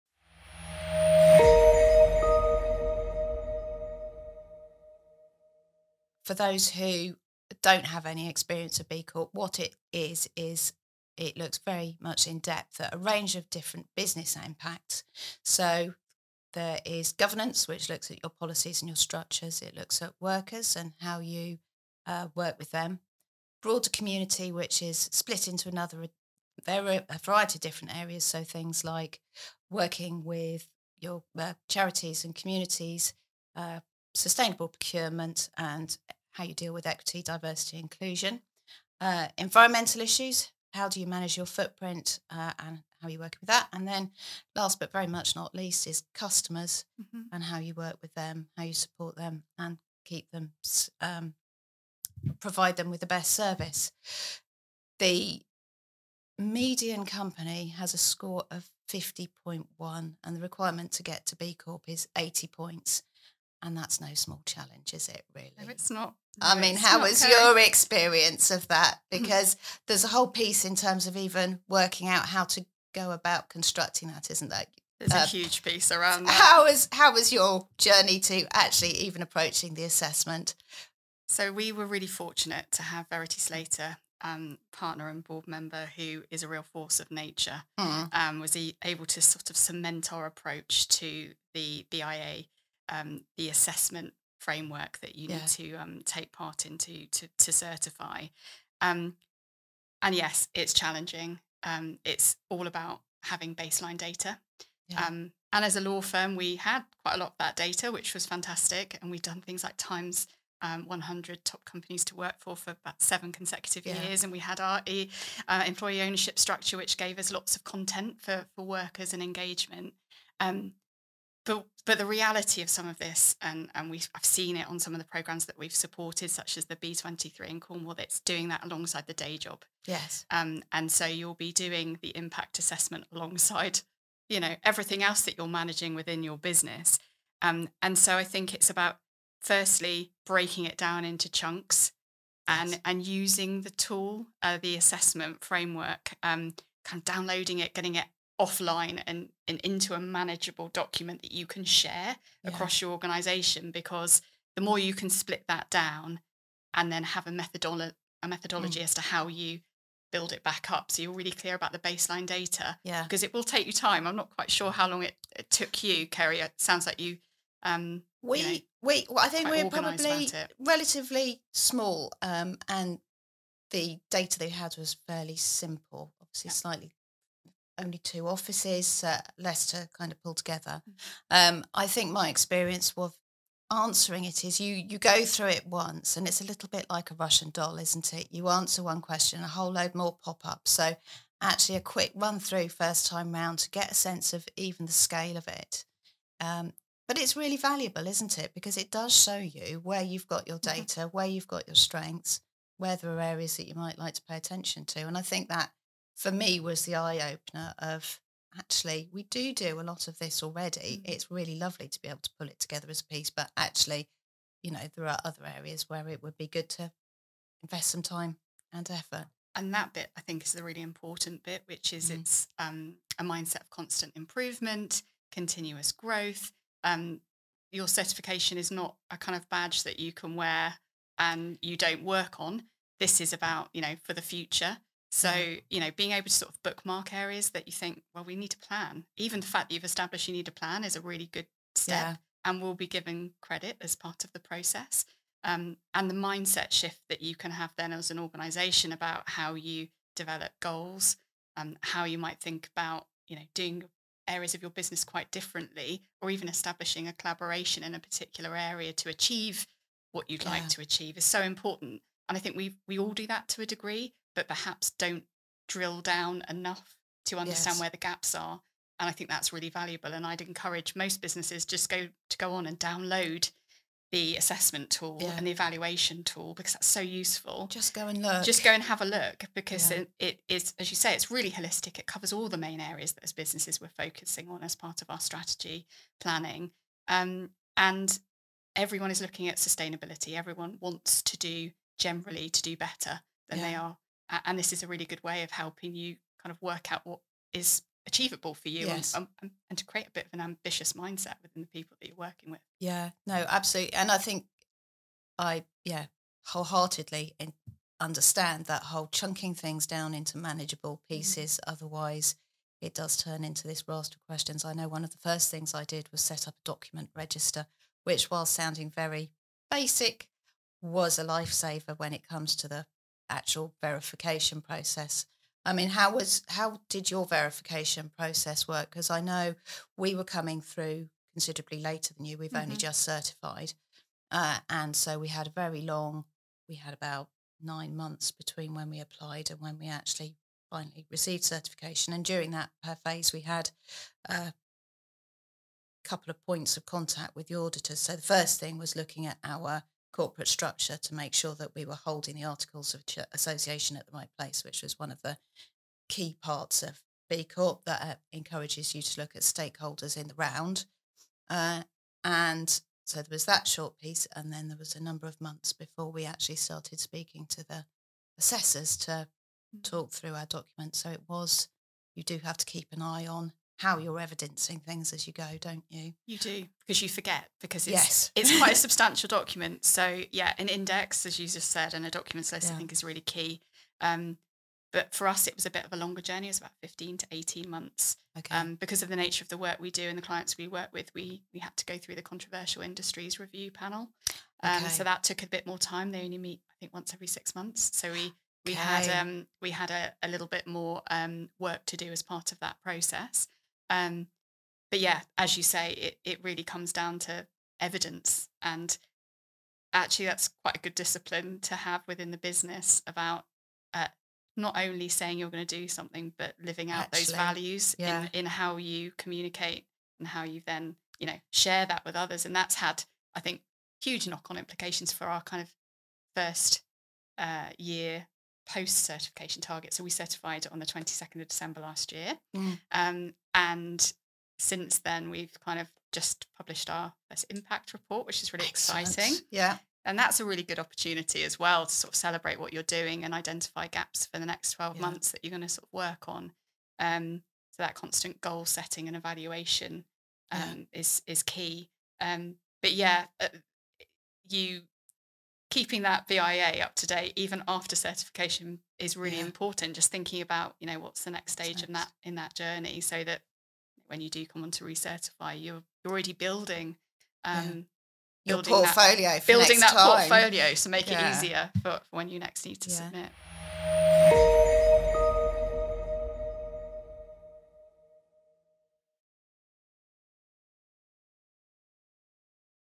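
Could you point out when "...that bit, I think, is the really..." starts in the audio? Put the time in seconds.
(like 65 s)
219 s.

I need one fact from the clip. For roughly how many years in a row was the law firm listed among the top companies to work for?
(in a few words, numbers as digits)
7.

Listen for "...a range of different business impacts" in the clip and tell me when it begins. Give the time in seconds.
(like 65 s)
12 s.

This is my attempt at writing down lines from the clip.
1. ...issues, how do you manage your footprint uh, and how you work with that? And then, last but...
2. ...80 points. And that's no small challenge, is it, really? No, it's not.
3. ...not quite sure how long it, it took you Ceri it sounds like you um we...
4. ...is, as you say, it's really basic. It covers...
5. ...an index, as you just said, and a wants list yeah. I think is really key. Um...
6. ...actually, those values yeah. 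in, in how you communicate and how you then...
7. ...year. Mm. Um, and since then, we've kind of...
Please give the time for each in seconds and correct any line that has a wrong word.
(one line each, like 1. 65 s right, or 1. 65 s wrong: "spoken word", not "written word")
1. 40 s right
2. 62 s right
3. 164 s right
4. 280 s wrong: "holistic", not "basic"
5. 380 s wrong: "documents", not "wants"
6. 417 s right
7. 432 s right.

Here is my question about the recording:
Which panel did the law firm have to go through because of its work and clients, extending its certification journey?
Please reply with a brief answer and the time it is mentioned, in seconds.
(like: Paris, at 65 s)
Controversial industries review panel, at 392 s.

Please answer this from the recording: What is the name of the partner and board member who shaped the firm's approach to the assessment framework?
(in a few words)
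Verity Slater.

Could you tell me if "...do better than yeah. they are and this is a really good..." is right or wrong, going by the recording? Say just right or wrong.
right.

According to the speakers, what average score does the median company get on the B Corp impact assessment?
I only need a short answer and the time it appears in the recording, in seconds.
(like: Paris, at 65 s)
50.1, at 58 s.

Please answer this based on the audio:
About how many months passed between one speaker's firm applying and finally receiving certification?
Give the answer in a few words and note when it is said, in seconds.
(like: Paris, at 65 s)
9, at 337 s.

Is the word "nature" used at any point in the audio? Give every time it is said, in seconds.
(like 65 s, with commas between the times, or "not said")
87 s, 389 s.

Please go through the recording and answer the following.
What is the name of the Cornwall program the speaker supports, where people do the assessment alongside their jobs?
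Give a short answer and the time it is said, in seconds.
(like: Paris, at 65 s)
B23, at 126 s.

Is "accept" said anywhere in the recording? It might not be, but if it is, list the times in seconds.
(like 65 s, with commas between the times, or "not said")
not said.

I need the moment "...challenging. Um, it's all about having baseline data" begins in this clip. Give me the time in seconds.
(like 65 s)
100 s.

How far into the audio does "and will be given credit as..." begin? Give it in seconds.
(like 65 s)
242 s.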